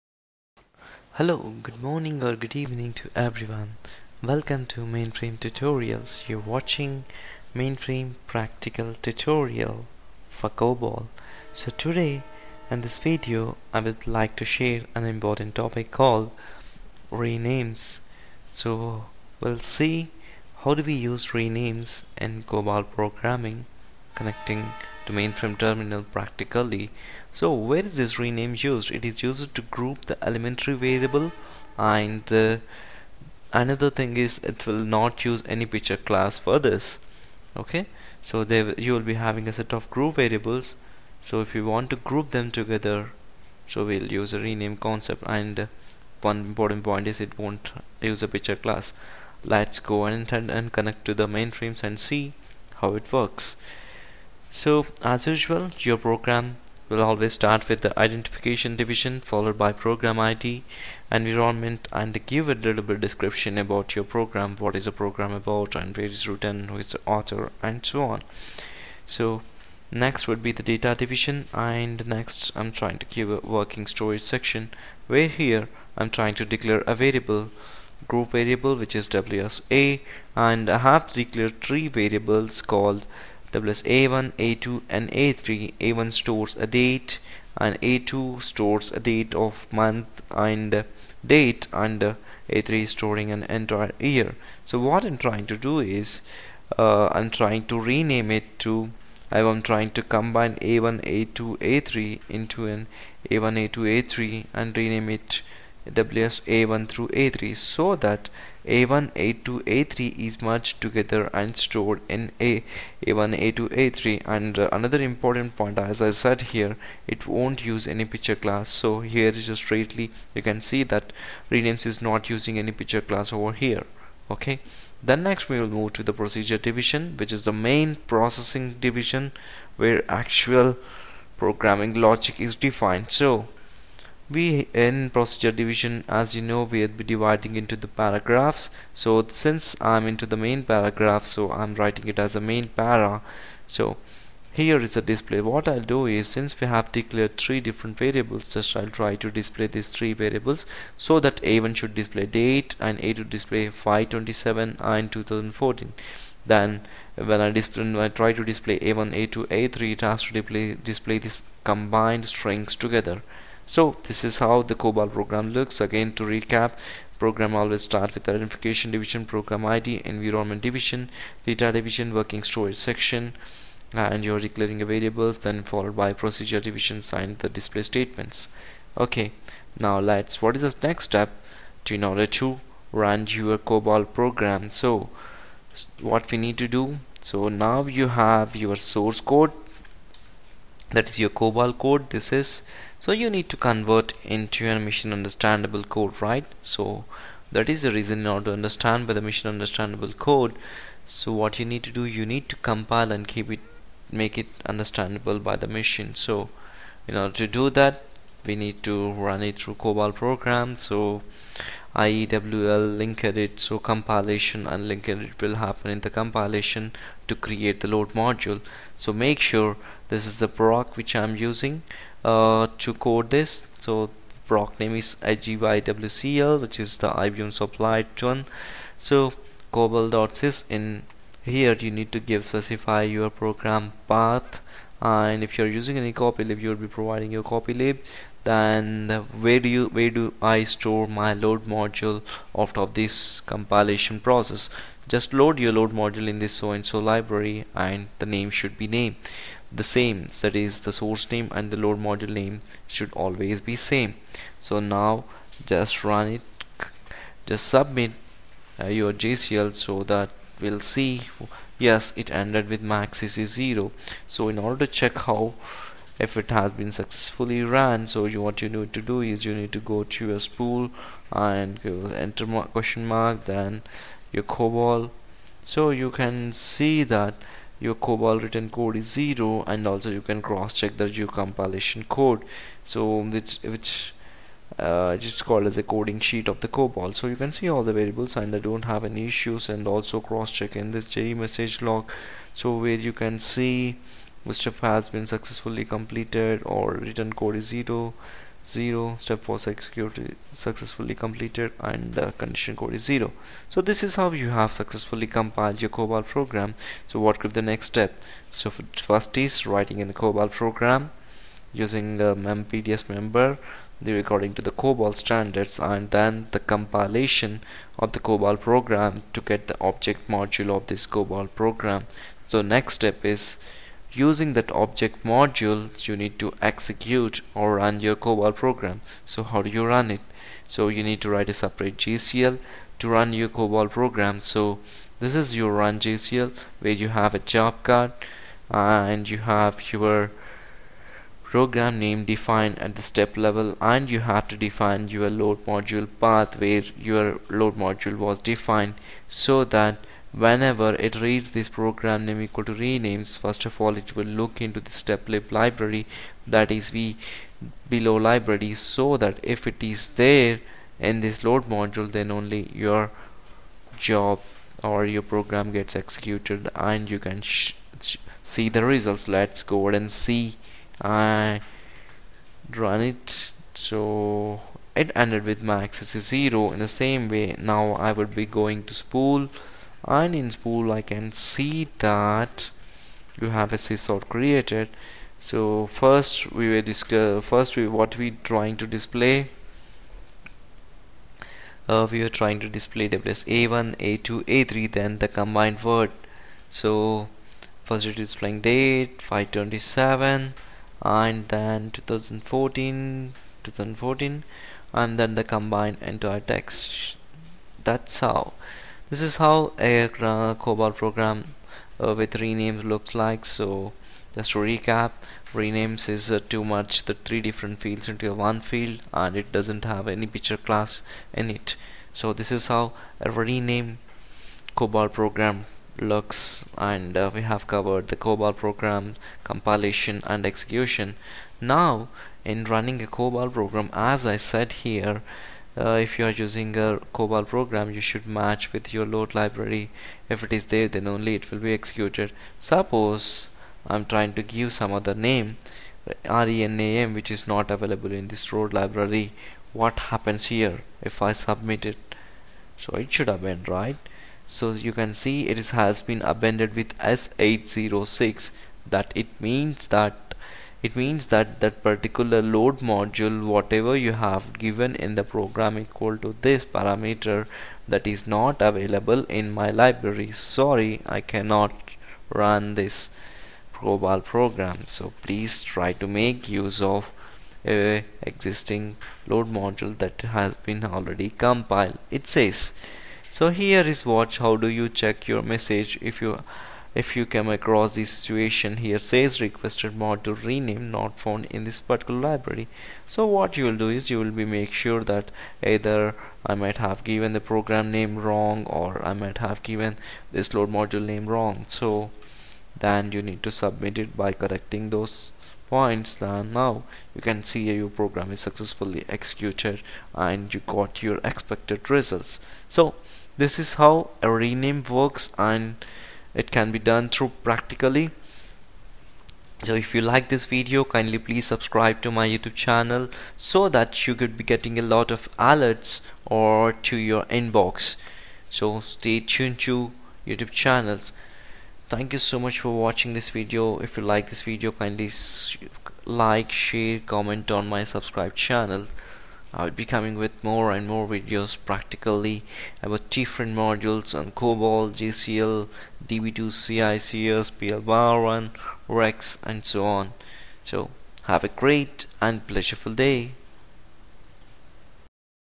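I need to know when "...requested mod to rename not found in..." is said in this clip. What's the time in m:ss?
8:09.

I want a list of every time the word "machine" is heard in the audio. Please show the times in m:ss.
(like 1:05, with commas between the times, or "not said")
3:14, 3:19, 3:25.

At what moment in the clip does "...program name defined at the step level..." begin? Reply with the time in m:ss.
5:41.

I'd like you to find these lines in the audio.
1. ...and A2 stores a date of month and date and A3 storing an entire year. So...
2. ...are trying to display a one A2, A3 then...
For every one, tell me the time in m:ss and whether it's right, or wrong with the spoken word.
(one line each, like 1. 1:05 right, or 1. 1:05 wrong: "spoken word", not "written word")
1. 1:27 right
2. 6:32 right.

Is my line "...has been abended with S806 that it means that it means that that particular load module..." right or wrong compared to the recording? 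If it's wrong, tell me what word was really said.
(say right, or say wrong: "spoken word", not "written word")
right.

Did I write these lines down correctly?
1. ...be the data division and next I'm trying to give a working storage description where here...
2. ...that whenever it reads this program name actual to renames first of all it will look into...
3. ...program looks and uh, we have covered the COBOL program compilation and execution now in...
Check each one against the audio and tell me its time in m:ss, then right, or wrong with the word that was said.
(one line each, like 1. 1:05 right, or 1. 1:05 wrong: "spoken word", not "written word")
1. 1:10 wrong: "section", not "description"
2. 5:49 wrong: "equal", not "actual"
3. 7:05 right.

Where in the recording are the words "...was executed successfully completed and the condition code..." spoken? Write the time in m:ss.
4:59.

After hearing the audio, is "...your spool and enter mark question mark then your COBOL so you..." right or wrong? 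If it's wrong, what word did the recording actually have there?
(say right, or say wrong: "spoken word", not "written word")
right.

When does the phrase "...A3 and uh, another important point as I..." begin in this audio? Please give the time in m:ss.
1:53.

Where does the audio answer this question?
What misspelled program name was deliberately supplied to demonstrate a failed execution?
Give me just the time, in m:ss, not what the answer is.
7:26.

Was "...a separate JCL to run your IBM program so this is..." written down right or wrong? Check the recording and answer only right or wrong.
wrong.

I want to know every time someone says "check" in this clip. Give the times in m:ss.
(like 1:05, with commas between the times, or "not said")
4:24, 4:40, 4:50, 8:04.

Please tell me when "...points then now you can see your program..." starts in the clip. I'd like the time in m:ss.
8:25.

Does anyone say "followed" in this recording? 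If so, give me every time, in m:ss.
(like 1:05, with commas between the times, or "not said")
0:59, 2:55.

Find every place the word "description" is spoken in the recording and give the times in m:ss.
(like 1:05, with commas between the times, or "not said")
1:02.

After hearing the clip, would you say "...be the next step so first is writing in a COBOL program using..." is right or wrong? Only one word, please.
right.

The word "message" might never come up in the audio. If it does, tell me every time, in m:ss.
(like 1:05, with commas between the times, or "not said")
4:51, 8:05.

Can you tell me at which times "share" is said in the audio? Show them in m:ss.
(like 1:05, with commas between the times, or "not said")
0:14, 8:56.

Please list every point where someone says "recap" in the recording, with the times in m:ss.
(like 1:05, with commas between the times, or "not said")
2:46, 6:54.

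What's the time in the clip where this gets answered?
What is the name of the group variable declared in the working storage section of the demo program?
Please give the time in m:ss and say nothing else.
1:19.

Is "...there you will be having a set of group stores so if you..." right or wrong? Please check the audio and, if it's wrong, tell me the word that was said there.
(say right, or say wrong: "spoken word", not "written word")
wrong: "variables", not "stores".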